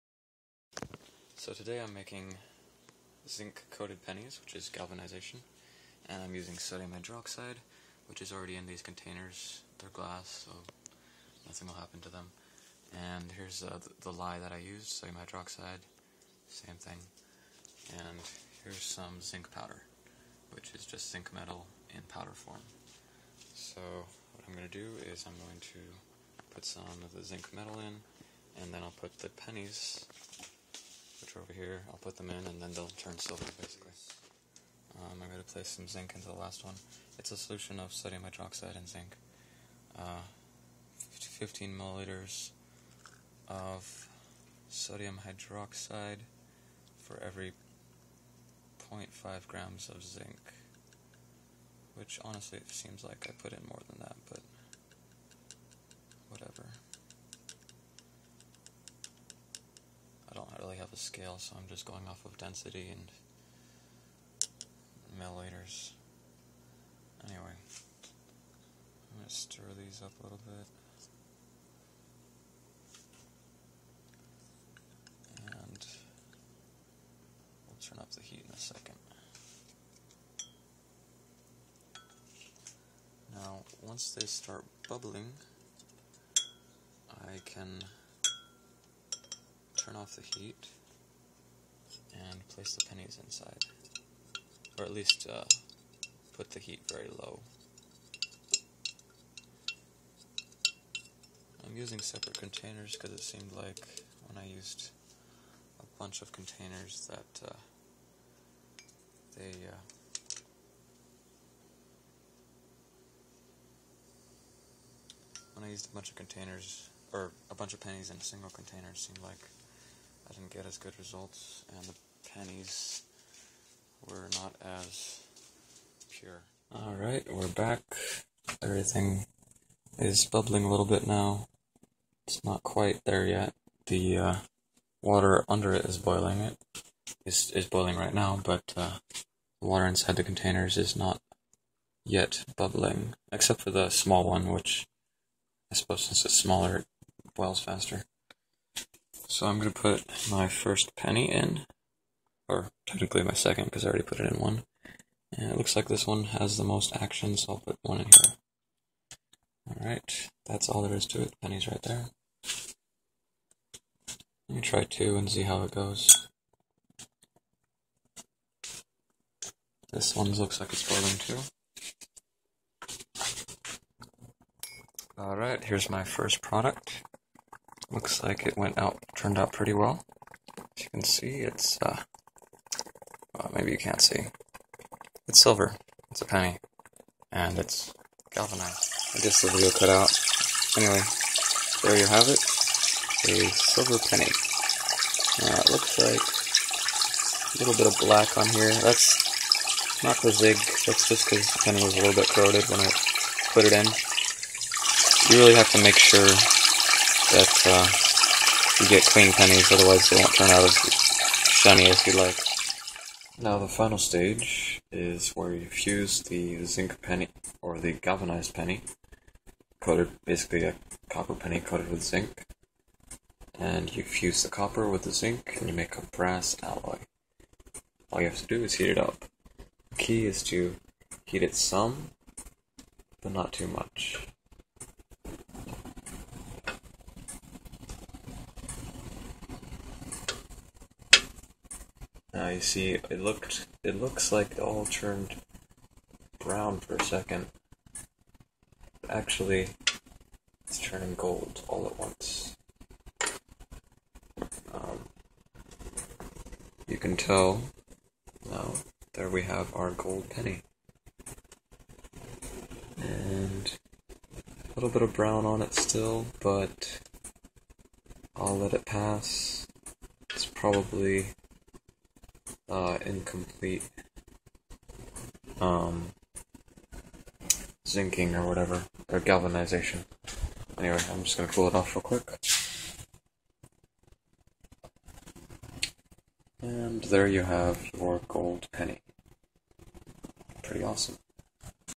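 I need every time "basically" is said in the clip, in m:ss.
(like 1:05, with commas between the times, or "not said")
0:33, 3:40.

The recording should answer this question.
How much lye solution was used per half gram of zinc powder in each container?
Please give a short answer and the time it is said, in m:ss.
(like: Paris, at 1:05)
15 milliliters, at 0:41.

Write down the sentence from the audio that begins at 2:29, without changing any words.
So I'm going to put my first penny in or technically my second because I already put it in one.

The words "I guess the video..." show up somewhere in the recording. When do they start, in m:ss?
3:09.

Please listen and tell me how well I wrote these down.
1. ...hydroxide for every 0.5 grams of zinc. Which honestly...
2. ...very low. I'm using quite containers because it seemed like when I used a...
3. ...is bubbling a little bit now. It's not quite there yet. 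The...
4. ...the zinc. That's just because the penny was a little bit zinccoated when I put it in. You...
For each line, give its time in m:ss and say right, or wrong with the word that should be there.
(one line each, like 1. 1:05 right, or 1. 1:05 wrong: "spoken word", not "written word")
1. 0:45 right
2. 1:36 wrong: "separate", not "quite"
3. 2:09 right
4. 3:20 wrong: "corroded", not "zinccoated".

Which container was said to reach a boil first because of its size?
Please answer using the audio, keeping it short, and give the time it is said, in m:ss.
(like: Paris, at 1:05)
the small one, at 2:23.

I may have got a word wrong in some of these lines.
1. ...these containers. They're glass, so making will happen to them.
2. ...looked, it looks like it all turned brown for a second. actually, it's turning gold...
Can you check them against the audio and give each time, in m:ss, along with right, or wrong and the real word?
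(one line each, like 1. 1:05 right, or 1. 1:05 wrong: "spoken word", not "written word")
1. 0:08 wrong: "nothing", not "making"
2. 4:03 right.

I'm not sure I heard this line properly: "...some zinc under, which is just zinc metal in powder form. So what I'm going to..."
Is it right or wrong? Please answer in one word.
wrong.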